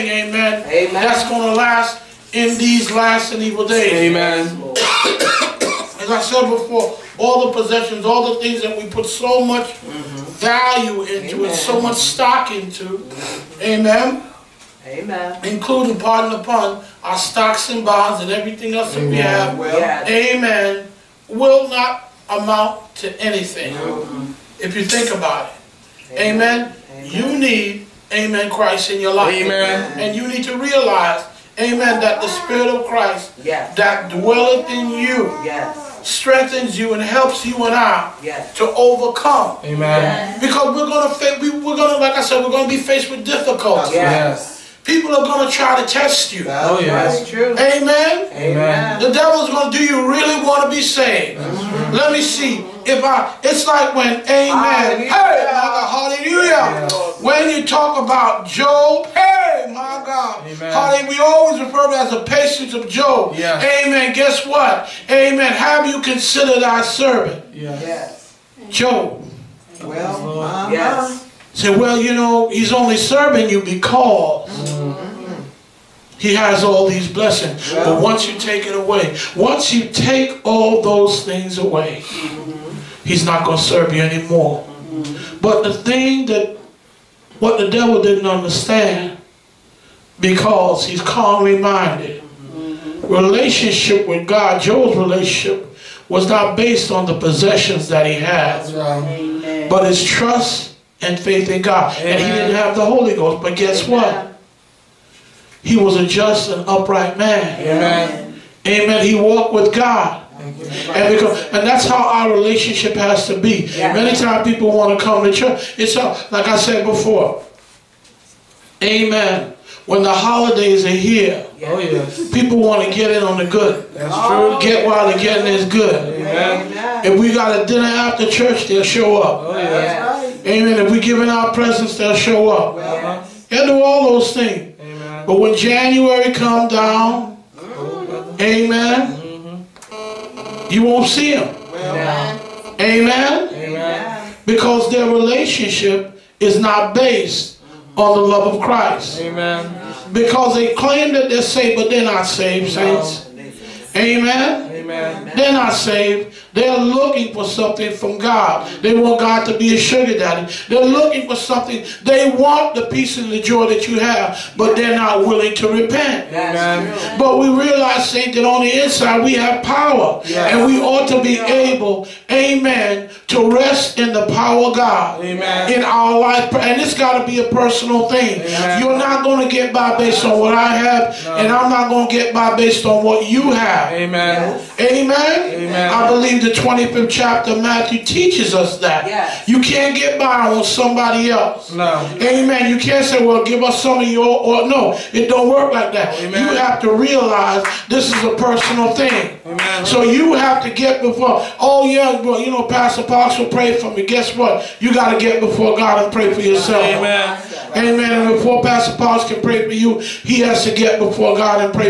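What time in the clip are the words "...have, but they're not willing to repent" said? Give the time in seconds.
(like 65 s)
163 s.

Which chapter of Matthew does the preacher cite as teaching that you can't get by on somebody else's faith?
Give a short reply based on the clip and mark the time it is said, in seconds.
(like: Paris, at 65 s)
25th, at 186 s.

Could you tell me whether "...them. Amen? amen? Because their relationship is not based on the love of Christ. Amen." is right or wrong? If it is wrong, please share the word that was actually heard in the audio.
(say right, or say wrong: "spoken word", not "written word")
right.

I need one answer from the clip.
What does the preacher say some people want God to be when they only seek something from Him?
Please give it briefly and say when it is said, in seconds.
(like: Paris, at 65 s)
Sugar daddy, at 159 s.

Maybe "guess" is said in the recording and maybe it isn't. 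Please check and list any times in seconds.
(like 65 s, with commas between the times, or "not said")
64 s, 103 s, 204 s.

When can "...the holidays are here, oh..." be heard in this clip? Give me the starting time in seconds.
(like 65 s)
120 s.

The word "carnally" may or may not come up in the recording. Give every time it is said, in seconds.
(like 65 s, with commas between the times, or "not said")
91 s.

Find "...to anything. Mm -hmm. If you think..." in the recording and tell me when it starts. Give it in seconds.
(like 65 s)
23 s.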